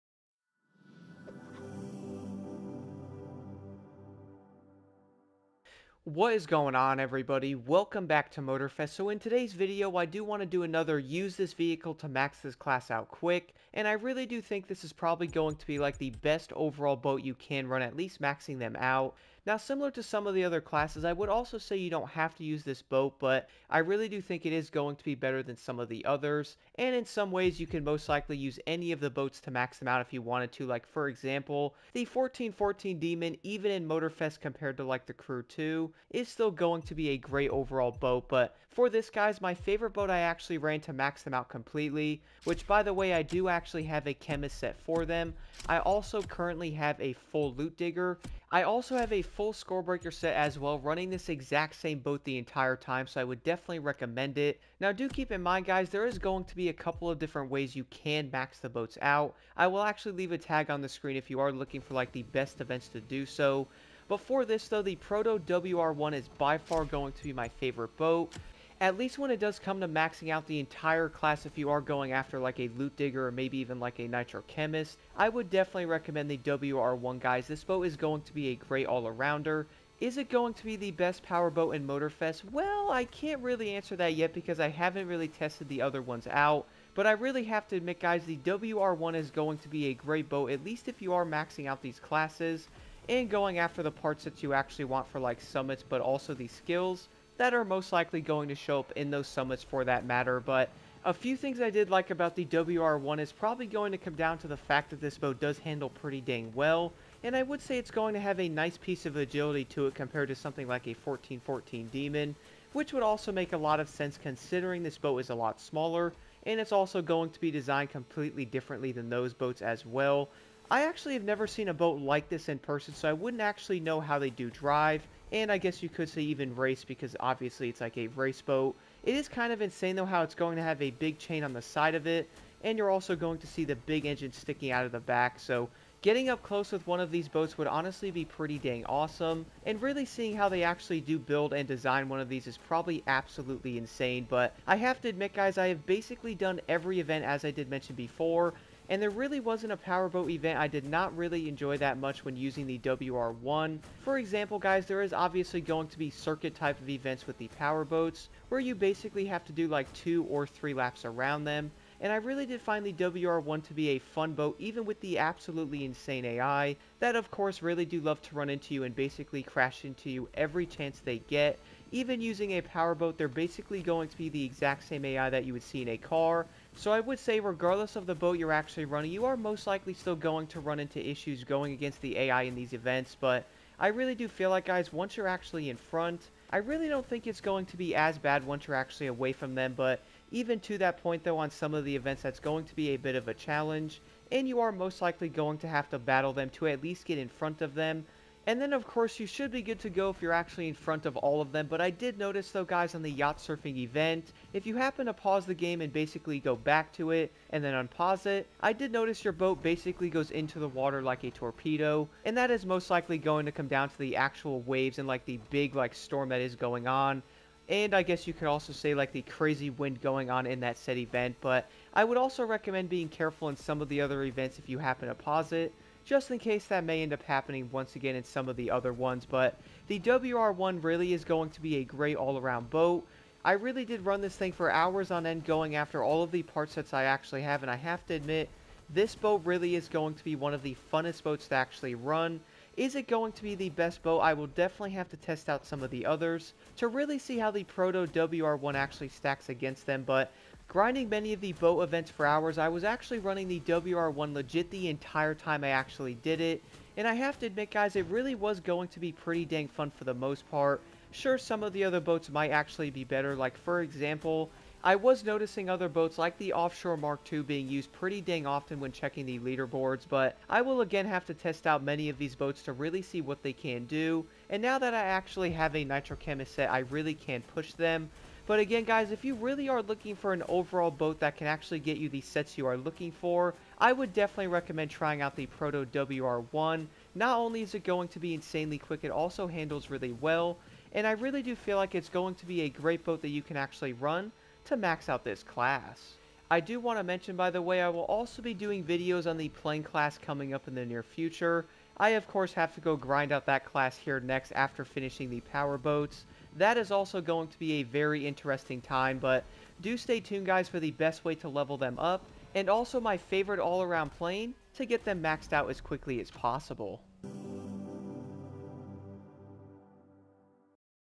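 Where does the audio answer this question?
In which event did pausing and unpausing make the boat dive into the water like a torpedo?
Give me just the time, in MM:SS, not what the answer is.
03:23.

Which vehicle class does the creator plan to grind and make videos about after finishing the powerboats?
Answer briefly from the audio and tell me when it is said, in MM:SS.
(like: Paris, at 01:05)
plane class, at 04:59.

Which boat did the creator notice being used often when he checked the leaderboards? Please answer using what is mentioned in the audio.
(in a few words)
Offshore Mark II.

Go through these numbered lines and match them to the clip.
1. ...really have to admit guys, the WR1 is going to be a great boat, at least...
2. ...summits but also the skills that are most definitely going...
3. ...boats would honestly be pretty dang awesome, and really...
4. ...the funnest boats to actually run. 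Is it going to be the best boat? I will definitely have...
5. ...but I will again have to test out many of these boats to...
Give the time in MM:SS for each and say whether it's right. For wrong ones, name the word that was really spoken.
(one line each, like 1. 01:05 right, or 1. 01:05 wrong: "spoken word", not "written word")
1. 01:27 right
2. 01:35 wrong: "likely", not "definitely"
3. 02:17 right
4. 04:00 right
5. 04:30 right.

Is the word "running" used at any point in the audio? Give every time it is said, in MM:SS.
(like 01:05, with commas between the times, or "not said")
00:50, 02:58, 04:13.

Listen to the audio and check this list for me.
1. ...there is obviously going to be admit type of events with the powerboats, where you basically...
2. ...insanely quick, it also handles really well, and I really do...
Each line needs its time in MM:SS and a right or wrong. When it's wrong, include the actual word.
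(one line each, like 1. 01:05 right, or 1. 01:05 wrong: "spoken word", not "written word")
1. 02:34 wrong: "circuit", not "admit"
2. 04:48 right.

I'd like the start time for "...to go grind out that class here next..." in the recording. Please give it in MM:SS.
05:02.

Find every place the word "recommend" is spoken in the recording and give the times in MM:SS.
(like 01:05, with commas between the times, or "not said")
00:53, 01:15, 03:42, 04:44.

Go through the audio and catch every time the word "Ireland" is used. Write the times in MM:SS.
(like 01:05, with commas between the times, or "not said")
not said.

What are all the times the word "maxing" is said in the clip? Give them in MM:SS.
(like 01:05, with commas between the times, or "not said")
00:18, 01:09, 01:31.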